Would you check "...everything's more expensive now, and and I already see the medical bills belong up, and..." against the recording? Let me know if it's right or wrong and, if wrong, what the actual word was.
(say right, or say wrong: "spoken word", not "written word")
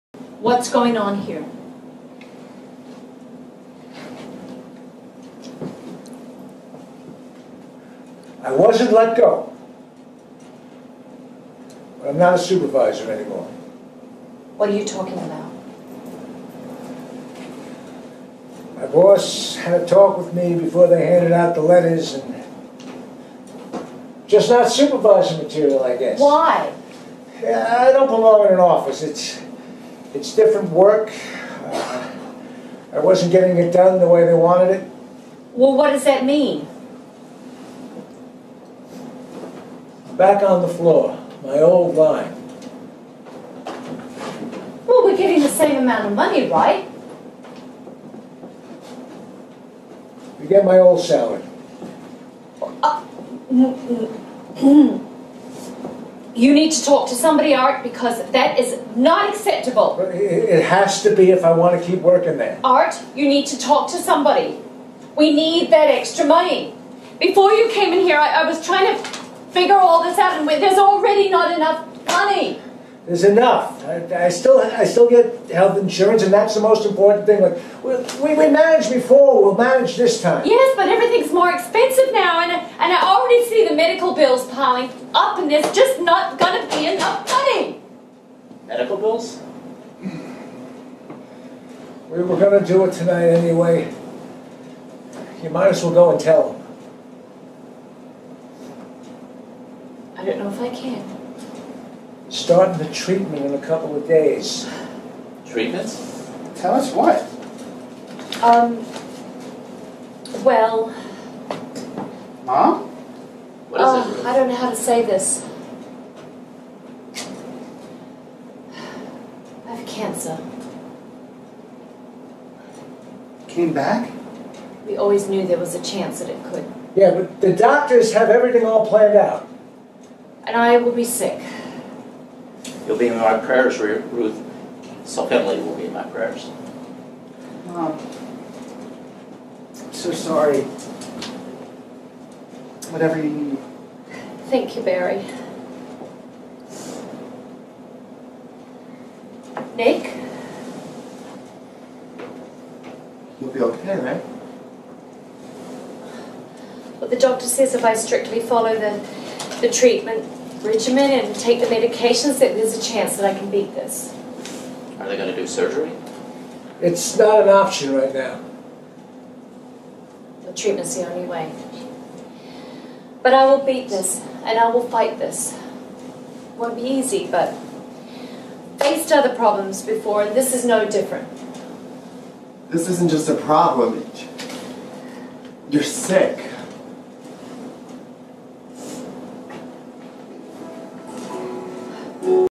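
wrong: "piling", not "belong".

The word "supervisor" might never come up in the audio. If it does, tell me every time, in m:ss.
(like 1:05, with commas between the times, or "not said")
0:12, 0:24.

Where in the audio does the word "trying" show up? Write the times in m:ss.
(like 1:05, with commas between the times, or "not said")
1:08.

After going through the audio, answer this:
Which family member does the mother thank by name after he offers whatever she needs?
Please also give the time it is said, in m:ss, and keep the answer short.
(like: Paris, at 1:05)
Barry, at 2:24.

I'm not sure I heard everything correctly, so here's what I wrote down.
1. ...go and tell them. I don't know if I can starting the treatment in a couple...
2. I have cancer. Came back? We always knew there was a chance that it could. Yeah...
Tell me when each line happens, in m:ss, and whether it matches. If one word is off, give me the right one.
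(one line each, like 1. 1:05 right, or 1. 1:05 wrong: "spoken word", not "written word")
1. 1:35 right
2. 1:59 right.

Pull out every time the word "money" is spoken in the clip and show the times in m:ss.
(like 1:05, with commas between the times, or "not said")
0:46, 1:06, 1:12, 1:27.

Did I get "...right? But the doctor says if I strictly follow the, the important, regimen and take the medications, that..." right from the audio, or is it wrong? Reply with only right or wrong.
wrong.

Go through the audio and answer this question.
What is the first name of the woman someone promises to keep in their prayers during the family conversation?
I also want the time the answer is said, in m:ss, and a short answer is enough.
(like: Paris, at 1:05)
Ruth, at 2:13.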